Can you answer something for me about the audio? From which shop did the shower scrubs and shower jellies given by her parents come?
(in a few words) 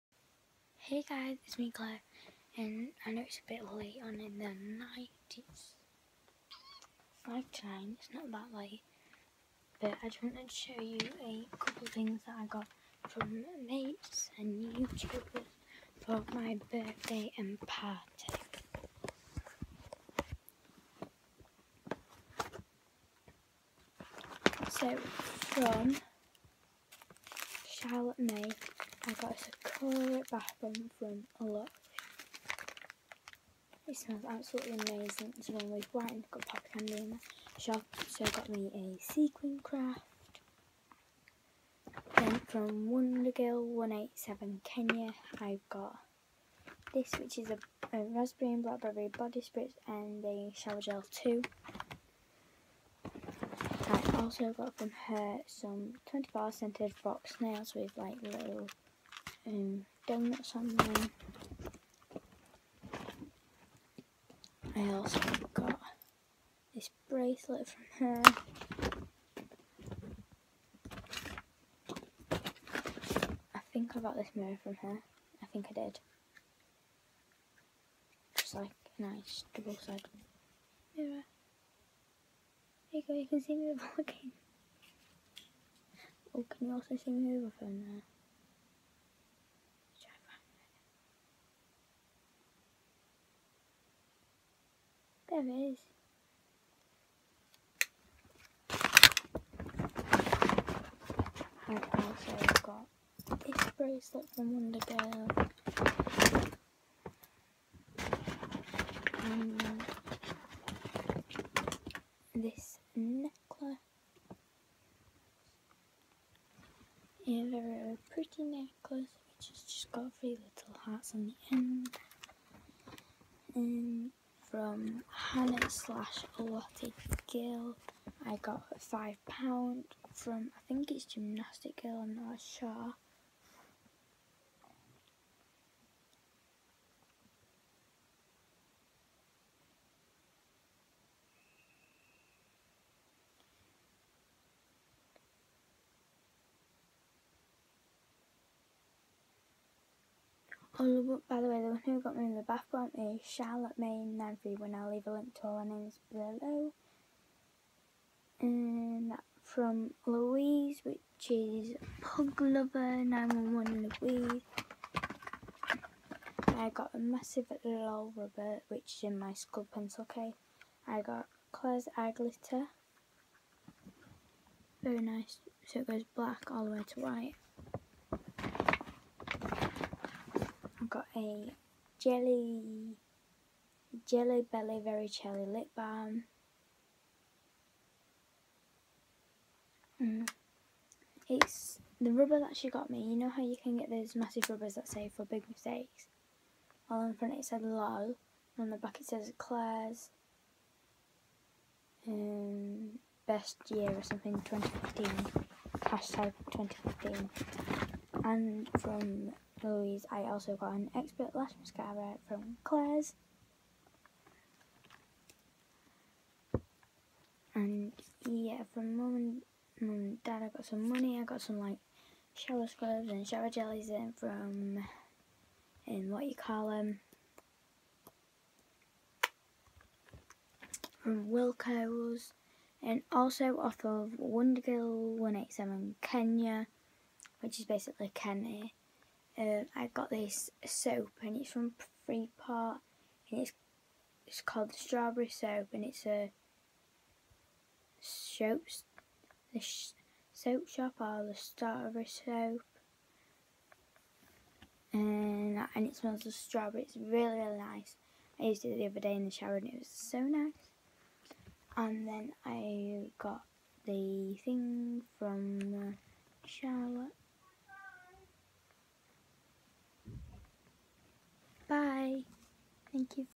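Wilko's.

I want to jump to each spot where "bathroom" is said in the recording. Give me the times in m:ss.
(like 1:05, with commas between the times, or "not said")
0:30.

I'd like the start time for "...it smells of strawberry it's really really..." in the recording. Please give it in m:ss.
4:15.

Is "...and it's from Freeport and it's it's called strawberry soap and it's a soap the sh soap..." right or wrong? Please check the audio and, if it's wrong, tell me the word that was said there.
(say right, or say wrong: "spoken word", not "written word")
right.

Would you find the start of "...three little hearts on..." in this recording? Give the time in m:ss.
2:00.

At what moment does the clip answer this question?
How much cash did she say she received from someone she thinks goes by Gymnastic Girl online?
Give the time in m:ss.
2:08.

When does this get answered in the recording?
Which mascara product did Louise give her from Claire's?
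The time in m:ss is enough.
3:30.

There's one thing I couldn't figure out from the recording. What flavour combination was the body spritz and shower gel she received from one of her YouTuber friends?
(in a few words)
raspberry and blackberry.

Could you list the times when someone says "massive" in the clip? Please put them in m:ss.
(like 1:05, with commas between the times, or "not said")
2:46, 3:14.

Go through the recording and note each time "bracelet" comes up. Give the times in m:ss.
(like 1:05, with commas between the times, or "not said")
1:07, 1:43.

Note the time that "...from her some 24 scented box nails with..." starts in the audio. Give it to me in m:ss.
0:54.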